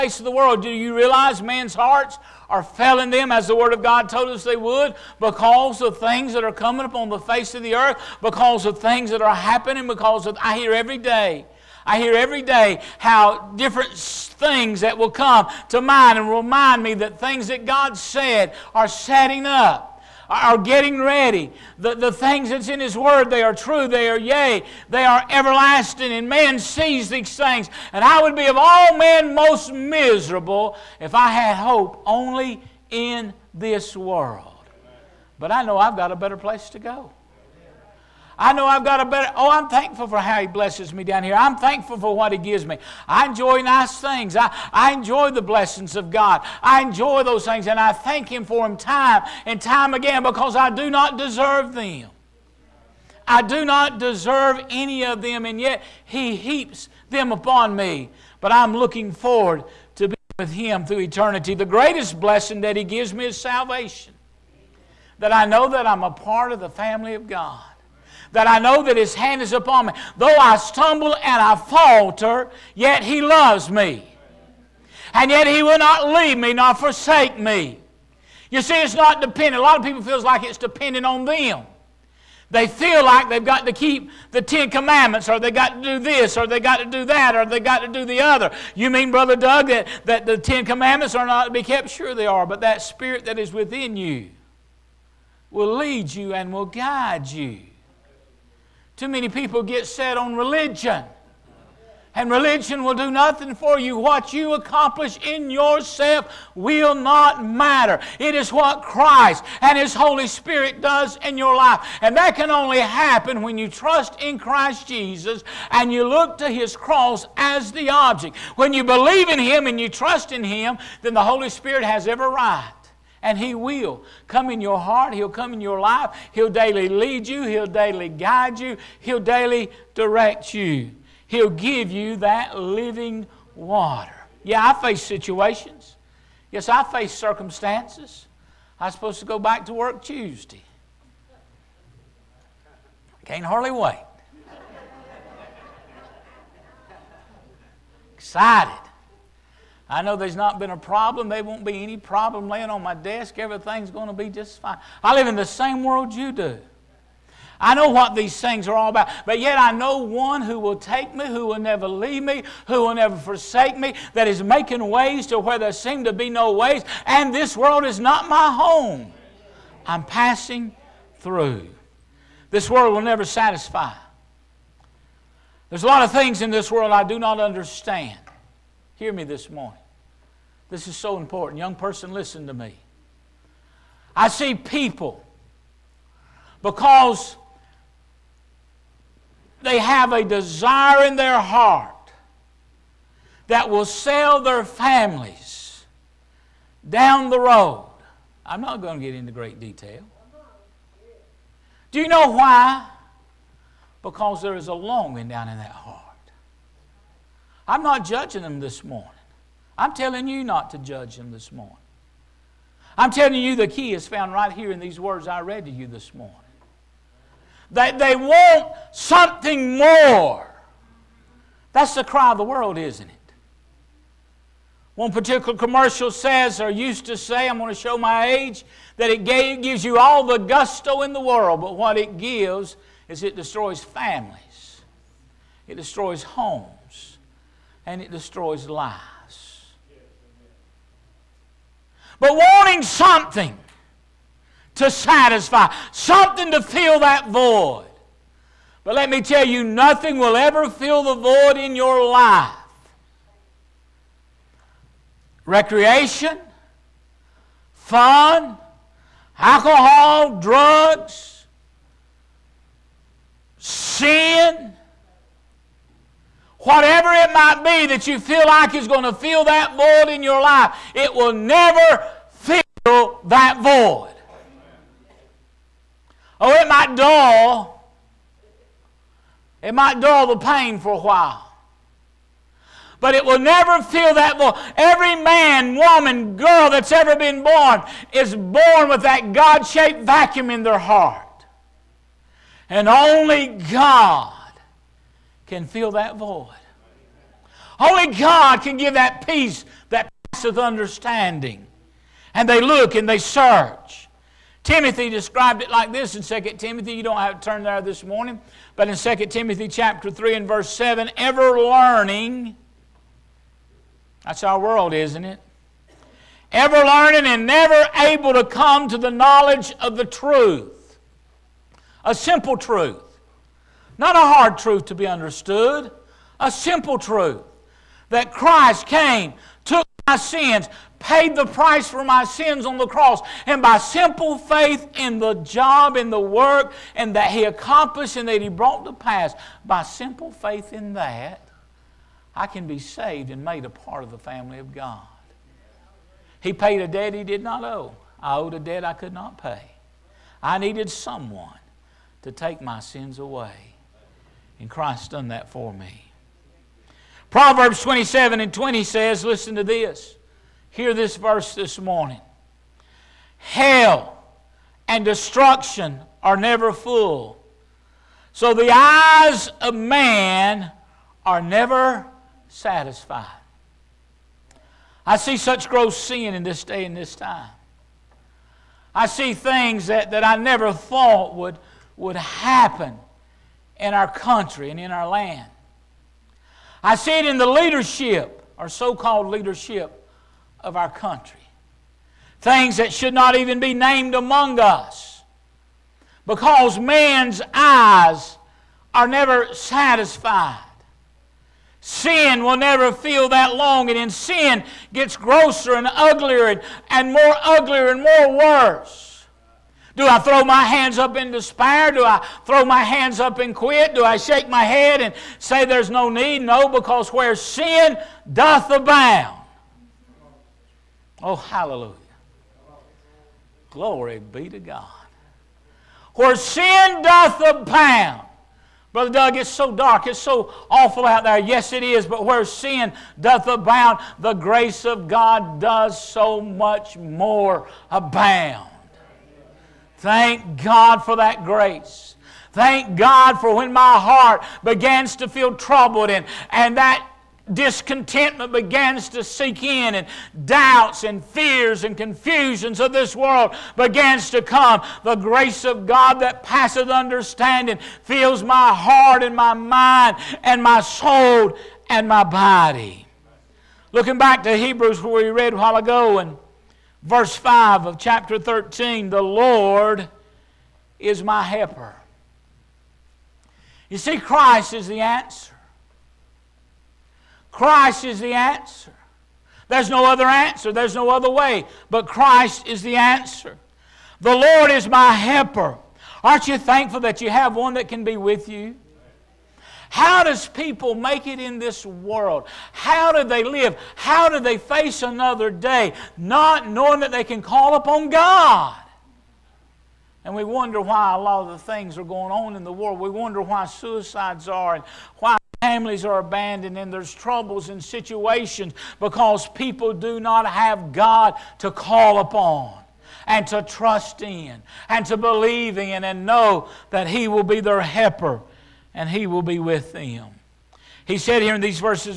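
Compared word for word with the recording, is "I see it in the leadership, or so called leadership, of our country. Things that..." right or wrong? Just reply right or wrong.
right.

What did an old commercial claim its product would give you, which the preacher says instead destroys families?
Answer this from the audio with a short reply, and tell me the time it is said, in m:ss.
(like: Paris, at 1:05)
all the gusto, at 3:49.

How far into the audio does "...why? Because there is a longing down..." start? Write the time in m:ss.
3:22.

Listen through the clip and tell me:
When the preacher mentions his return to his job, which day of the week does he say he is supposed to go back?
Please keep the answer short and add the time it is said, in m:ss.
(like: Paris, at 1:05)
Tuesday, at 2:20.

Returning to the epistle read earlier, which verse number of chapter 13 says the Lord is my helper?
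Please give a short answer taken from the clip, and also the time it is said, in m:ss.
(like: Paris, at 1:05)
5, at 7:47.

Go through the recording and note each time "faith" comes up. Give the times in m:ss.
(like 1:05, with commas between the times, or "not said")
5:34, 5:40.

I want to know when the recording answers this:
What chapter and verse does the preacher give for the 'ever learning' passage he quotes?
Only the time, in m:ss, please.
5:09.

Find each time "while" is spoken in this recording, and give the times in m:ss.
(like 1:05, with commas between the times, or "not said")
4:40, 7:45.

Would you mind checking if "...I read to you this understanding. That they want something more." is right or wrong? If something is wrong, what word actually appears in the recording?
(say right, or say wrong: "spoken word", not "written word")
wrong: "morning", not "understanding".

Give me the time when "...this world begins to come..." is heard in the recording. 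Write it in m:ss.
7:32.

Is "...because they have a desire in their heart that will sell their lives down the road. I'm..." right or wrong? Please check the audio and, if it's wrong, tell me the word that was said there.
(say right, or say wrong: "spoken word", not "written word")
wrong: "families", not "lives".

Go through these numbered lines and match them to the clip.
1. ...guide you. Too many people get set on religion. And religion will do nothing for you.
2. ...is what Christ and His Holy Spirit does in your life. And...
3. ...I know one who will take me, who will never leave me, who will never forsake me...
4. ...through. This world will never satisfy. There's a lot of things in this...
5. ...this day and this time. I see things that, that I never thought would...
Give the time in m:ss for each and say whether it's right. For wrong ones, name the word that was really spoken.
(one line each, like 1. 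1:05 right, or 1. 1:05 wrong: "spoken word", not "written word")
1. 1:36 right
2. 1:48 right
3. 2:39 right
4. 2:51 right
5. 6:16 right.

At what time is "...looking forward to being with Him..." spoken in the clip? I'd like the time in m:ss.
0:58.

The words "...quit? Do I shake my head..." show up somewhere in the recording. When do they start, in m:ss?
6:53.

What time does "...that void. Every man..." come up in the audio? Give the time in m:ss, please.
4:44.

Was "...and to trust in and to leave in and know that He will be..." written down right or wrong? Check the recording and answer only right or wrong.
wrong.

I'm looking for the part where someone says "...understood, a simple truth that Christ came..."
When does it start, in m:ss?
5:25.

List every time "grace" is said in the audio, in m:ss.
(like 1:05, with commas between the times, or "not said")
7:14, 7:21, 7:35.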